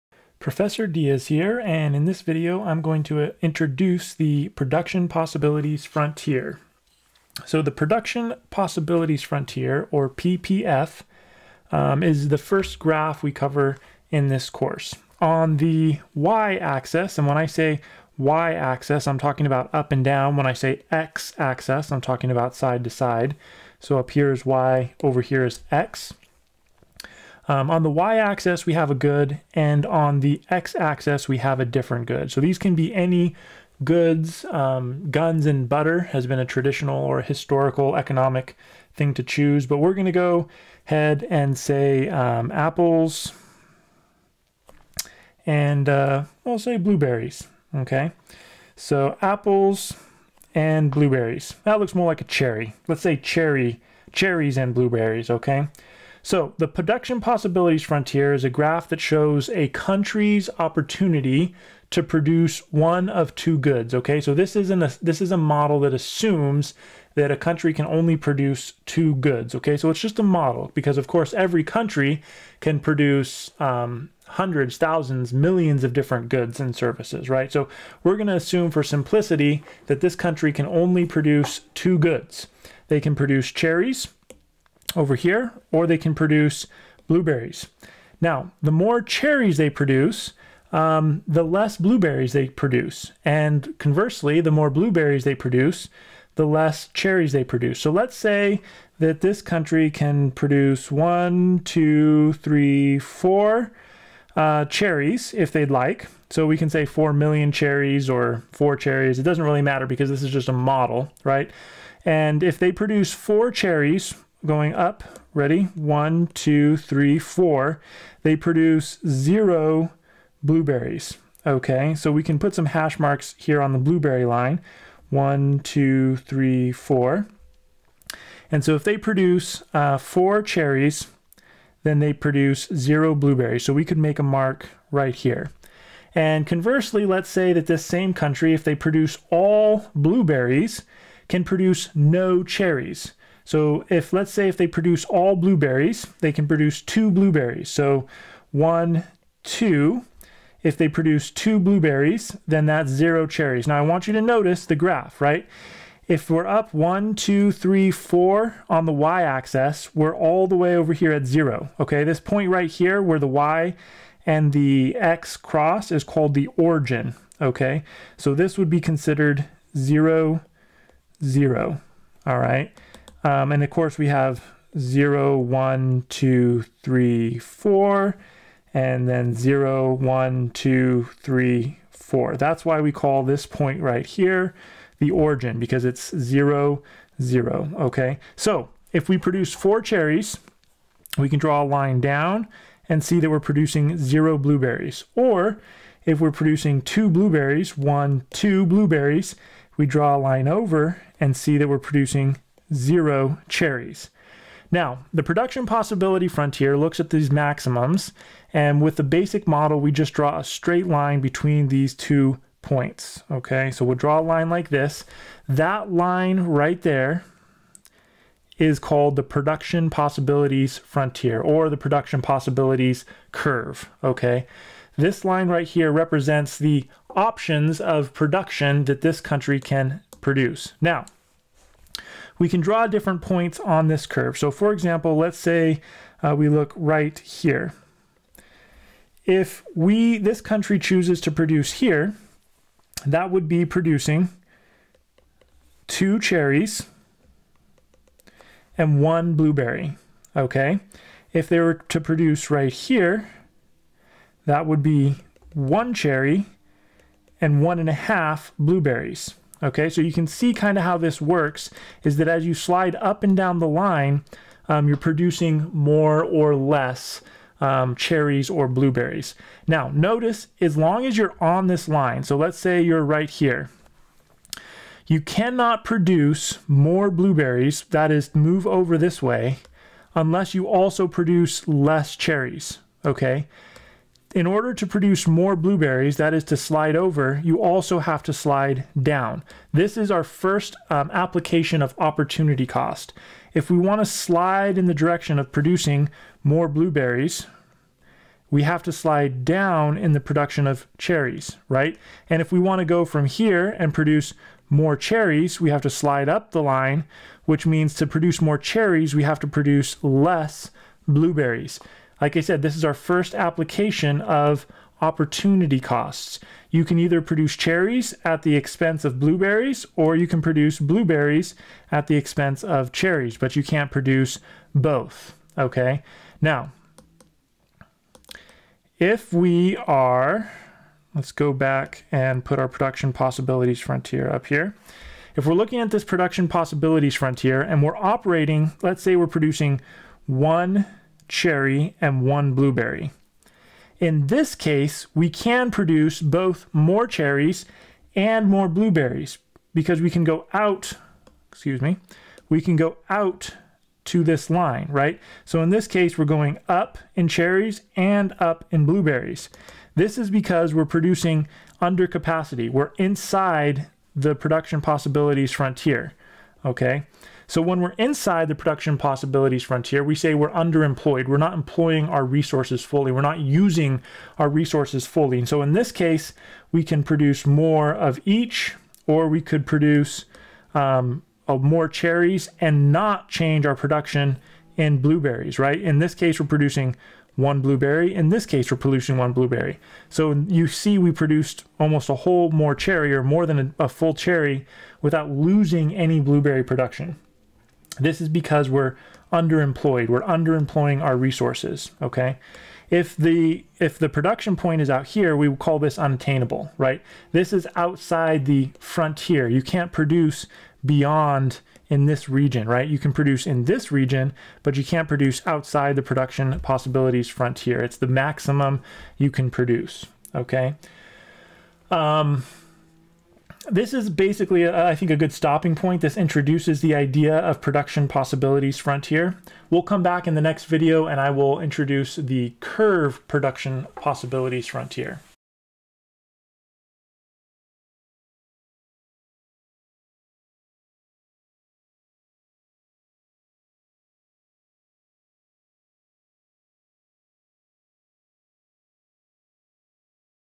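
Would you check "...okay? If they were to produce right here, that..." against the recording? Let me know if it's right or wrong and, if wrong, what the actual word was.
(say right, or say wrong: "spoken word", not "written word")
right.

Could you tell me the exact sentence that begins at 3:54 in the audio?
So for example, let's say uh, we look right here.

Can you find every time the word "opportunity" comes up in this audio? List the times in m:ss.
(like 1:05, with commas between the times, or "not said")
1:00, 4:51, 5:15.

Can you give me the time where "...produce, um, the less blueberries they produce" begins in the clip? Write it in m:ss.
1:29.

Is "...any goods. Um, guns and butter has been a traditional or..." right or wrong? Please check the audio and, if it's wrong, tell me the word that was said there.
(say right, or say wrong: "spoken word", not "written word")
right.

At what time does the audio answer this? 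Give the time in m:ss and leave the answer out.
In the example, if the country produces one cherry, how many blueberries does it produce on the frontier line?
4:17.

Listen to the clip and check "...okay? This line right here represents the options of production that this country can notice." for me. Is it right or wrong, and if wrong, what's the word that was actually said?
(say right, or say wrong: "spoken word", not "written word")
wrong: "produce", not "notice".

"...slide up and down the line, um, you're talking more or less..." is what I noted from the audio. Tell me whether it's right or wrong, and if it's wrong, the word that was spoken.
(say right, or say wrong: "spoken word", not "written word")
wrong: "producing", not "talking".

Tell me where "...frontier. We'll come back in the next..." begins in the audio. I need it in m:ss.
7:08.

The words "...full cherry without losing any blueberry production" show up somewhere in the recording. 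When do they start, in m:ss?
6:33.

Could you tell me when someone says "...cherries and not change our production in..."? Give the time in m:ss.
6:21.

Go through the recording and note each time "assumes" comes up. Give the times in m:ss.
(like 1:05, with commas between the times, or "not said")
1:05, 1:18.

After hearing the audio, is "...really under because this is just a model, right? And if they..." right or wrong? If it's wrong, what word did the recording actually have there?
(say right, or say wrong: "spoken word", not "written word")
wrong: "matter", not "under".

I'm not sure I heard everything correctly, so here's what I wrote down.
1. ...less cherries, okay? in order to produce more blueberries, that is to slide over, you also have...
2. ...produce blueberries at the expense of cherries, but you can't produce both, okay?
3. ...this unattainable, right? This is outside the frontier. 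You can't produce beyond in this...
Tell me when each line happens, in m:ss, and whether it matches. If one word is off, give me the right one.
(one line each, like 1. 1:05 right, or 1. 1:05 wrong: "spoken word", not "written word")
1. 4:41 right
2. 5:20 right
3. 6:45 right.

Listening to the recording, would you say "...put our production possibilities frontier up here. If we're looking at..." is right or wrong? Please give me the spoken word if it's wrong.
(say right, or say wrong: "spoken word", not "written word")
right.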